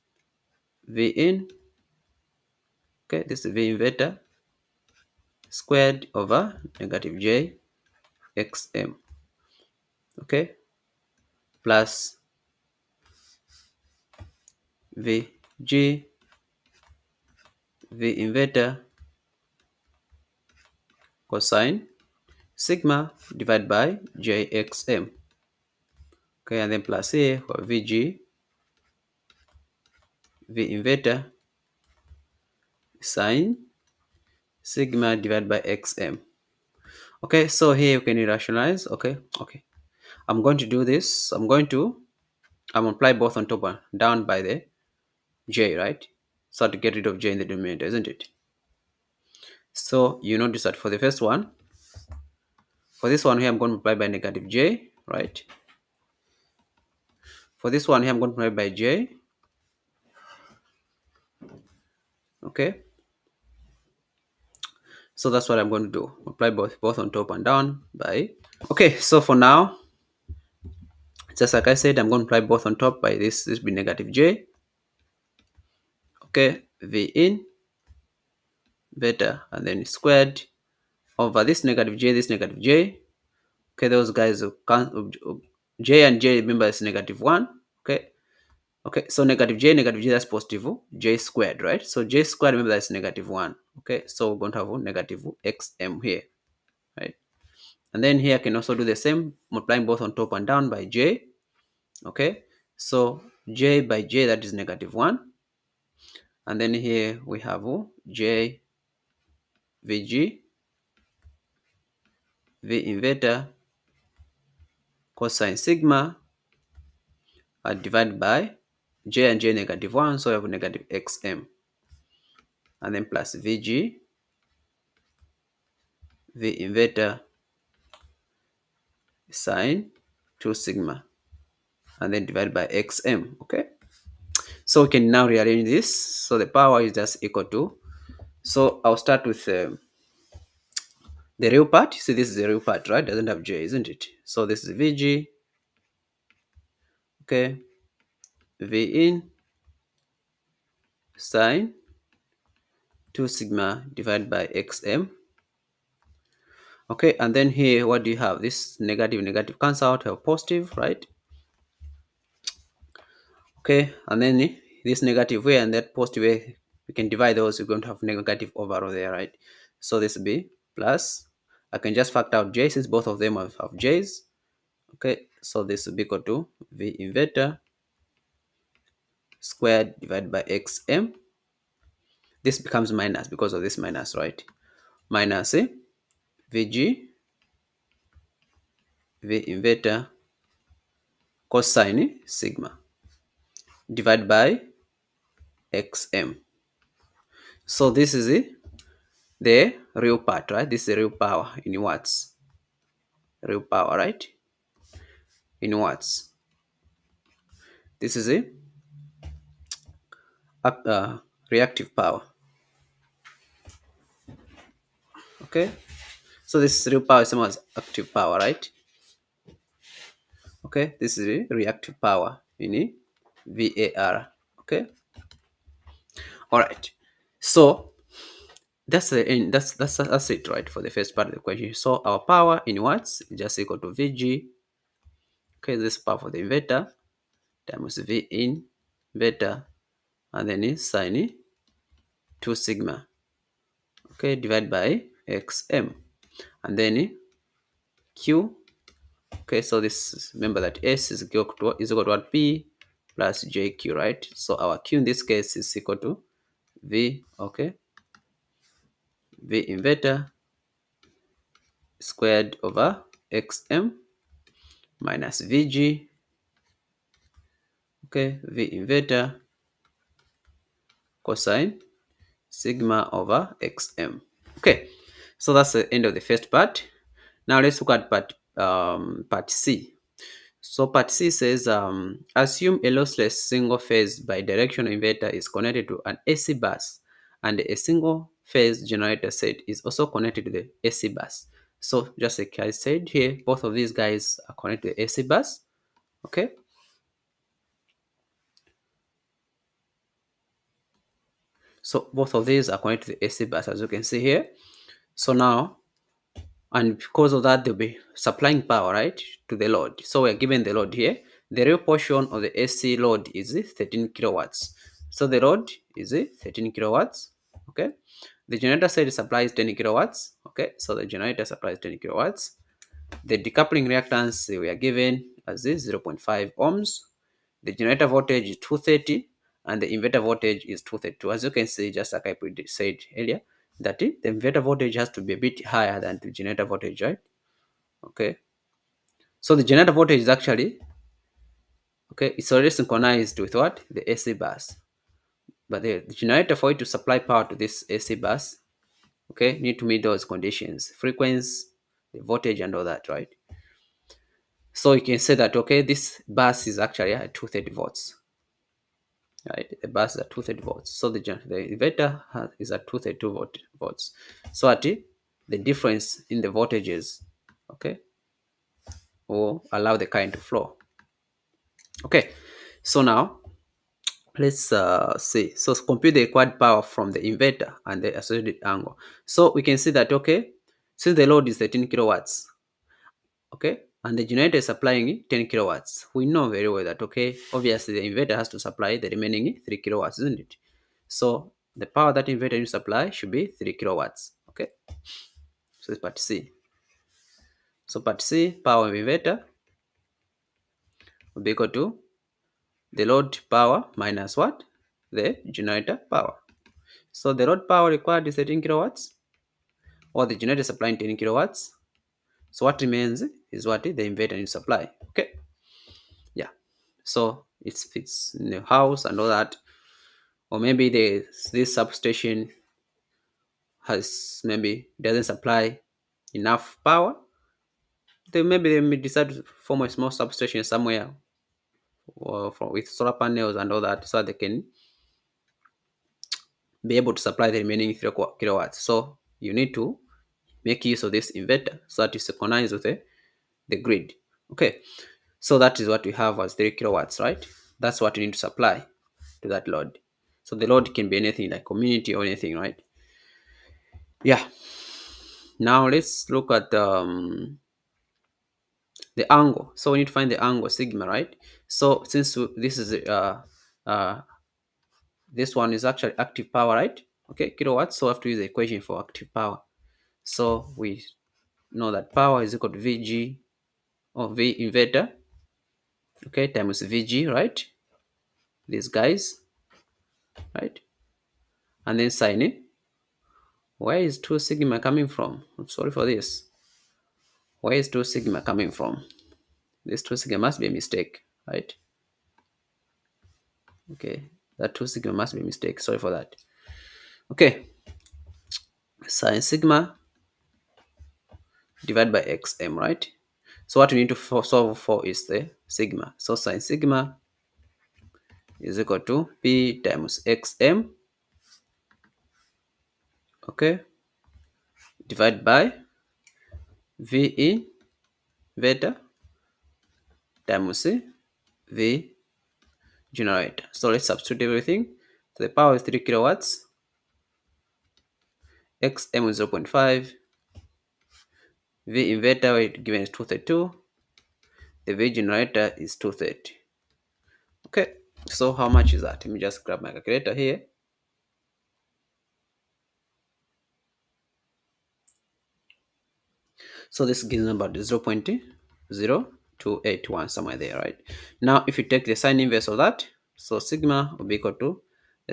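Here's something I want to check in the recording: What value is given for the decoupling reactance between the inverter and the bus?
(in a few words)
0.5 ohms.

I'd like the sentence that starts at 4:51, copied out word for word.
So just like I said here, both of these guys are connected to the AC bus.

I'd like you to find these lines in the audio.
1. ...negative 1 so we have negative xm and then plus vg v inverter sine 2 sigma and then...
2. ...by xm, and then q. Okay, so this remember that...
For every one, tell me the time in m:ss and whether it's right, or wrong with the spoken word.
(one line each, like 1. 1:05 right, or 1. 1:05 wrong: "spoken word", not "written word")
1. 1:59 right
2. 4:04 right.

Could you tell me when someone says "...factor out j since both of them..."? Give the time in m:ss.
2:52.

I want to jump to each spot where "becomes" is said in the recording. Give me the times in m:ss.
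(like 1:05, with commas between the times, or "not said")
3:02.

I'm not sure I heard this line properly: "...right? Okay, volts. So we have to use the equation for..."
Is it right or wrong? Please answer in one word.
wrong.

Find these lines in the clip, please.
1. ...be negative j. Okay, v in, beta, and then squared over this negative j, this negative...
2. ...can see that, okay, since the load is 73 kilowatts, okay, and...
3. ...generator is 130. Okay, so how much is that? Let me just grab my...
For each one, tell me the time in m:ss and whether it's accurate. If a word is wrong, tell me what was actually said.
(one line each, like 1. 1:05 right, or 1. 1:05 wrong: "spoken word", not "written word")
1. 1:13 right
2. 6:19 wrong: "13", not "73"
3. 8:55 wrong: "230", not "130".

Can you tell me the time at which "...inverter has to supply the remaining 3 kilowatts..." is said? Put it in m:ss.
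6:28.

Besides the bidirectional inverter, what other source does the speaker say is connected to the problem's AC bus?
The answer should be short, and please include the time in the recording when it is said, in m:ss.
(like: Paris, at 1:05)
single phase generator set, at 4:47.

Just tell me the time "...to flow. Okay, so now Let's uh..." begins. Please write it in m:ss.
6:10.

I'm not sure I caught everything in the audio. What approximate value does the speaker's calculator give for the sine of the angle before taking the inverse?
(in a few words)
0.0281.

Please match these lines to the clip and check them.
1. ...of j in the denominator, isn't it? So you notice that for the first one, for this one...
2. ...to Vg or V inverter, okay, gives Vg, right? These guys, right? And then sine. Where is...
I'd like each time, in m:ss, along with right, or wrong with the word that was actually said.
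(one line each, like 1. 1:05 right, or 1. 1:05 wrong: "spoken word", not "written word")
1. 0:47 right
2. 7:52 wrong: "times", not "gives".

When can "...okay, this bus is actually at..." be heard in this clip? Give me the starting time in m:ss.
5:55.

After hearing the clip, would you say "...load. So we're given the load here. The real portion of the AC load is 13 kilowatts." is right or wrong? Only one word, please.
right.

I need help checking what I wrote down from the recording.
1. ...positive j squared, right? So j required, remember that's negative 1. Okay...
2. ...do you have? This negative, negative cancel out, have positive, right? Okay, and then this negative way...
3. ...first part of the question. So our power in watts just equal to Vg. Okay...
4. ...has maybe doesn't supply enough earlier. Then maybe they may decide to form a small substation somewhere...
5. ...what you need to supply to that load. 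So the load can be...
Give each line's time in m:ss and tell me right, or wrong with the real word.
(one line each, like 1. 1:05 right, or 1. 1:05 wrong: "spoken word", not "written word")
1. 1:30 wrong: "squared", not "required"
2. 2:38 right
3. 3:50 right
4. 7:03 wrong: "power", not "earlier"
5. 7:27 right.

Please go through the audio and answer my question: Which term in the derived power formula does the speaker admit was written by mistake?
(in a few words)
2 sigma.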